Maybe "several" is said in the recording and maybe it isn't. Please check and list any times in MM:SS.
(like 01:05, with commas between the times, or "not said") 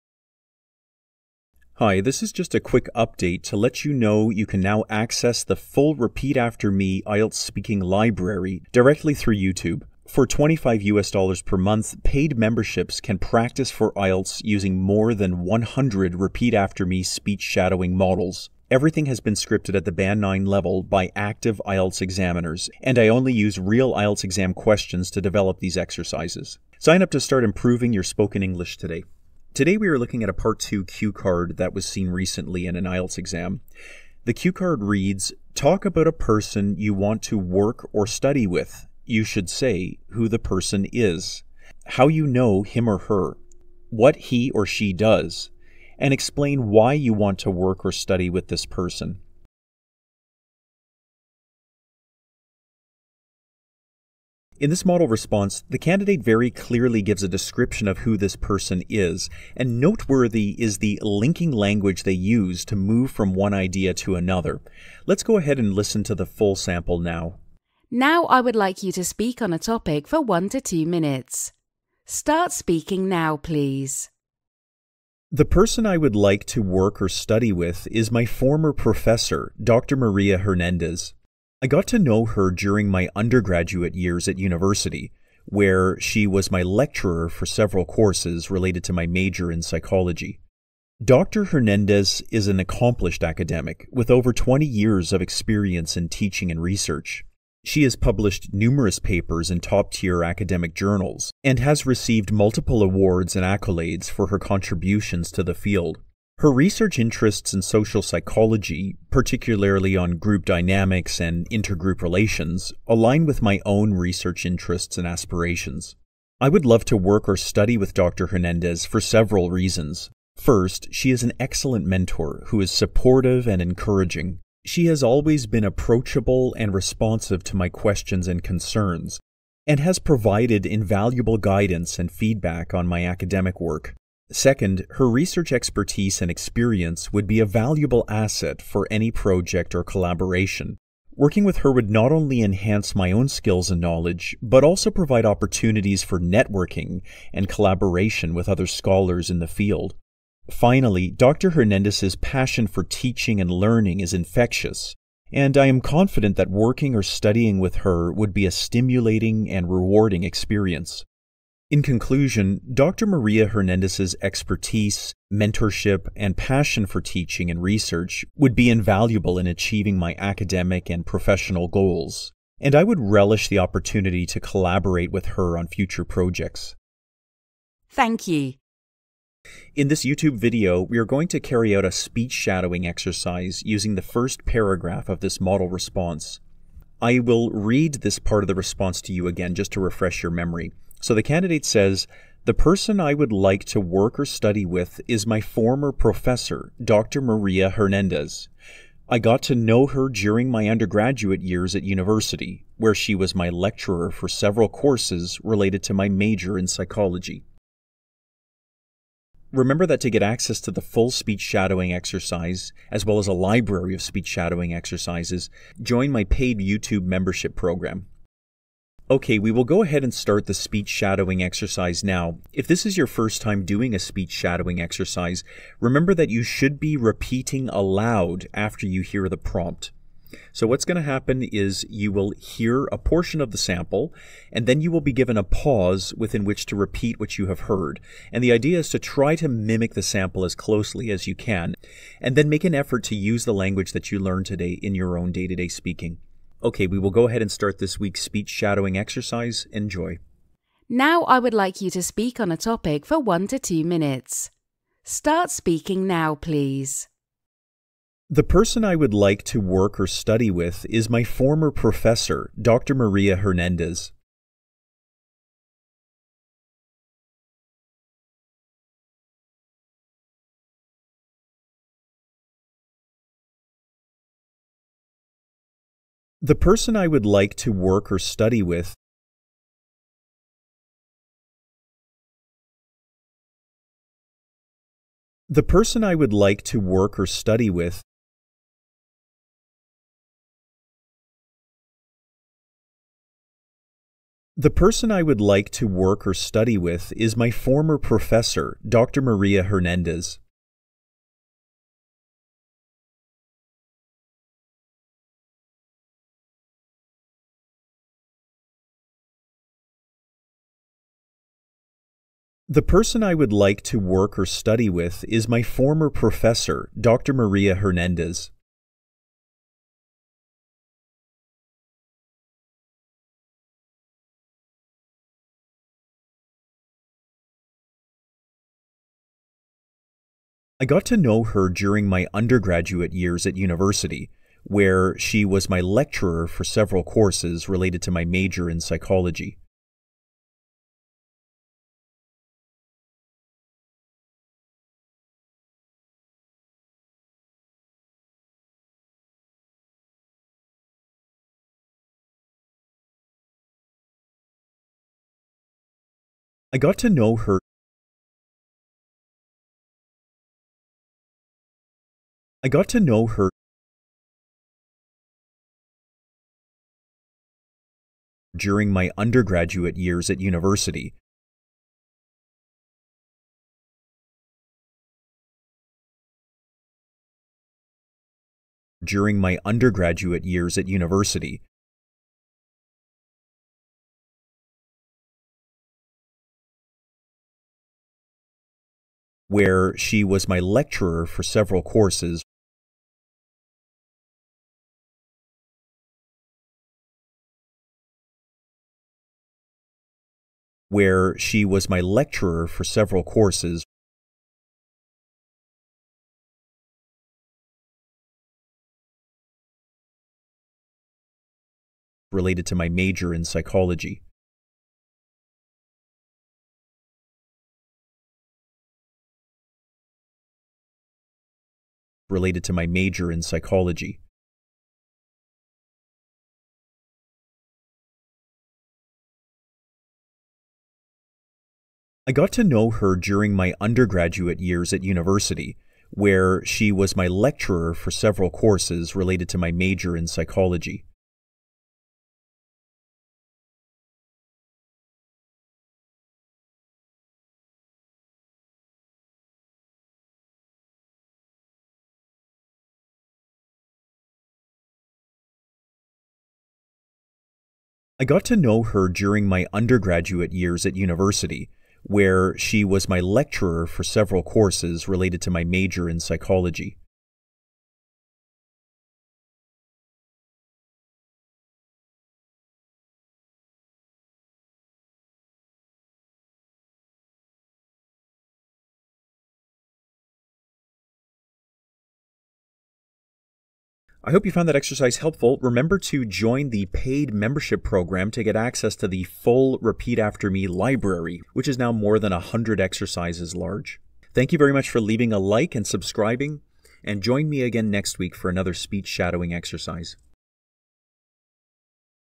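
01:27, 01:58, 03:24, 05:36, 06:31, 06:42, 07:18, 07:44.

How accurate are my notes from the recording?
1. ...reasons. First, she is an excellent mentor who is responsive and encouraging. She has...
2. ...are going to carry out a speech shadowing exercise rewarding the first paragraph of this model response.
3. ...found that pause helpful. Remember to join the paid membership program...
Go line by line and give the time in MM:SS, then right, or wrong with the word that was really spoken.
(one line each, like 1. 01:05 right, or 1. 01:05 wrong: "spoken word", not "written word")
1. 01:59 wrong: "supportive", not "responsive"
2. 03:00 wrong: "using", not "rewarding"
3. 08:04 wrong: "exercise", not "pause".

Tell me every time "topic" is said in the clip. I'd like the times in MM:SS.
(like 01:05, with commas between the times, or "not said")
01:09, 04:12.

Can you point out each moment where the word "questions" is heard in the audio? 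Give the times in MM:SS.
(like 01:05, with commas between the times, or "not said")
00:24, 02:07.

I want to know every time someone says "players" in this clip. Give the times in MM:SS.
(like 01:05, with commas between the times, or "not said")
not said.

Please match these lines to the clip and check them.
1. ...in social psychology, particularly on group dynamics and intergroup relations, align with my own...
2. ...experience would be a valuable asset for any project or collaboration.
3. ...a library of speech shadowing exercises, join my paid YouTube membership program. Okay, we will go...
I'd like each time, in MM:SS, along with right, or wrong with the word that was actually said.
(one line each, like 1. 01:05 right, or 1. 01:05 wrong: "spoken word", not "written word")
1. 01:47 right
2. 02:16 right
3. 03:33 right.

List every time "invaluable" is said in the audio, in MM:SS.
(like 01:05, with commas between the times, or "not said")
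02:10, 02:48.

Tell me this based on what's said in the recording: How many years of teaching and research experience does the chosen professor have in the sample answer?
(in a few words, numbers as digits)
over 20.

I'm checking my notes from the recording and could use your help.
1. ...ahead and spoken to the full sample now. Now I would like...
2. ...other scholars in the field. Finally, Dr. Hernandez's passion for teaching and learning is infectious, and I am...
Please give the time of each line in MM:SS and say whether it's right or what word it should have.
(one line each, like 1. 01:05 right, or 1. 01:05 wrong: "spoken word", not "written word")
1. 01:05 wrong: "listen", not "spoken"
2. 02:28 right.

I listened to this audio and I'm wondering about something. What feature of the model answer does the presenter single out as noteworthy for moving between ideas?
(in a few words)
linking language.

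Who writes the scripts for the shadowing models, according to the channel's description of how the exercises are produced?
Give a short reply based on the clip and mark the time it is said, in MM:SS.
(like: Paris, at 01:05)
active IELTS examiners, at 00:21.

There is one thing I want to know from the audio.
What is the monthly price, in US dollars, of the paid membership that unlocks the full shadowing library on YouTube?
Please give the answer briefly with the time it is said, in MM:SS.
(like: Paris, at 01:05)
25 US dollars, at 00:10.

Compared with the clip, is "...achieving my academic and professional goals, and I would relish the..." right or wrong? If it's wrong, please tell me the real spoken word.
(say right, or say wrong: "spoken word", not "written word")
right.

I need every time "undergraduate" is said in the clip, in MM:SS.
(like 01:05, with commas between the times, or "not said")
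01:23, 03:20, 05:32, 06:09, 06:19, 07:13, 07:39.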